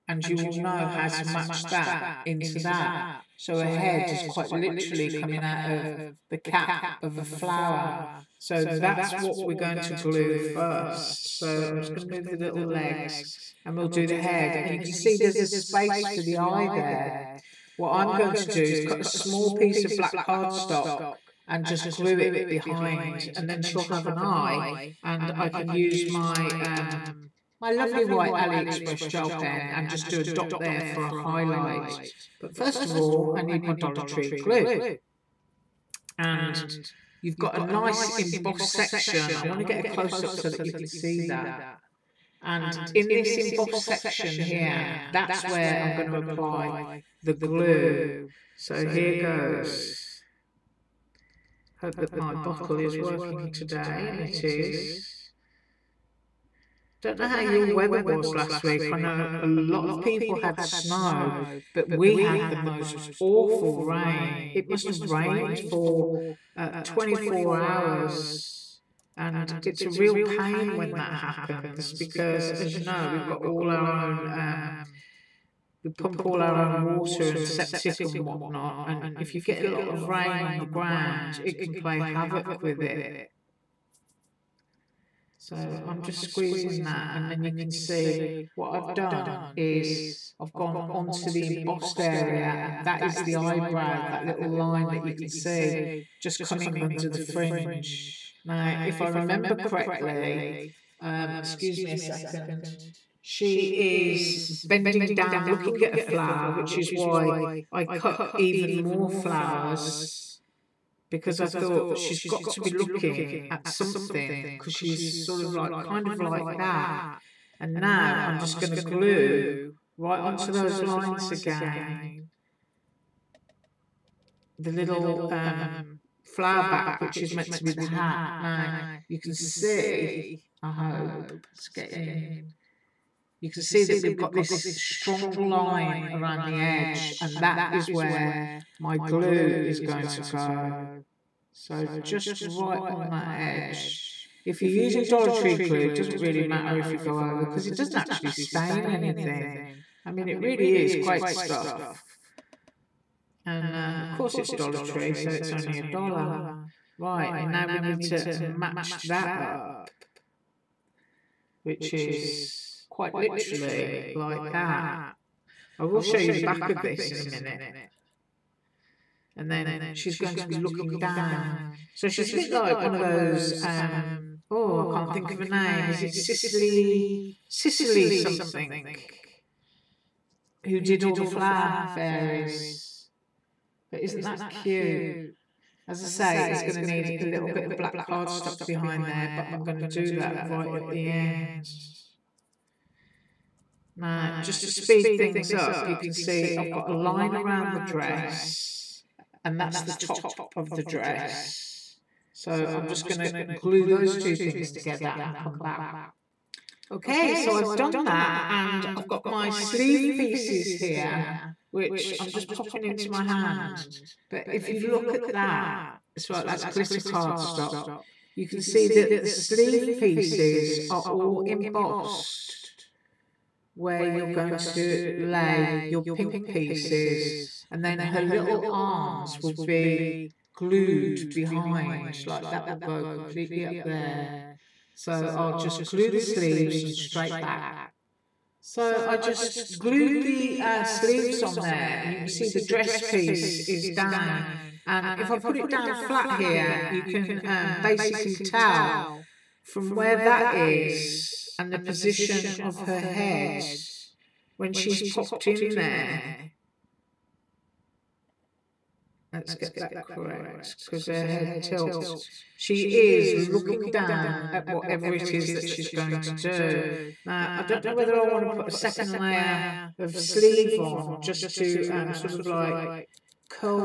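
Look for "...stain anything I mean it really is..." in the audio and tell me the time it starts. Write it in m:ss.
2:28.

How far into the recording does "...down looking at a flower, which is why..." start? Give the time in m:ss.
1:45.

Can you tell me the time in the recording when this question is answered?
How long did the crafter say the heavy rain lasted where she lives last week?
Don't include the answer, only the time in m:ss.
1:06.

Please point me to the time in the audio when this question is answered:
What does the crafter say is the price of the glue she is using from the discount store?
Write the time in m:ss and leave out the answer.
2:35.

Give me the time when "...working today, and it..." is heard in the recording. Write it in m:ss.
0:52.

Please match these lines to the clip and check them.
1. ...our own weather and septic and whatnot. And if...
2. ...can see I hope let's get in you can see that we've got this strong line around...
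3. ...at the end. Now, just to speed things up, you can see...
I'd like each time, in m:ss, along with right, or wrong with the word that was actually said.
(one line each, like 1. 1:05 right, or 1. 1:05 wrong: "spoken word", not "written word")
1. 1:16 wrong: "water", not "weather"
2. 2:09 right
3. 3:10 right.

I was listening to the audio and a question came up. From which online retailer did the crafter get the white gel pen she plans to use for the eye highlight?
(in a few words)
AliExpress.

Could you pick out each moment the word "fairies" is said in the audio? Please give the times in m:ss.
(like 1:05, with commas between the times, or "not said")
3:01.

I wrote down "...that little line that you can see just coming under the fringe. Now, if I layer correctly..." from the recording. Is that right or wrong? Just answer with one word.
wrong.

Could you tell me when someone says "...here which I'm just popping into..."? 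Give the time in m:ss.
3:30.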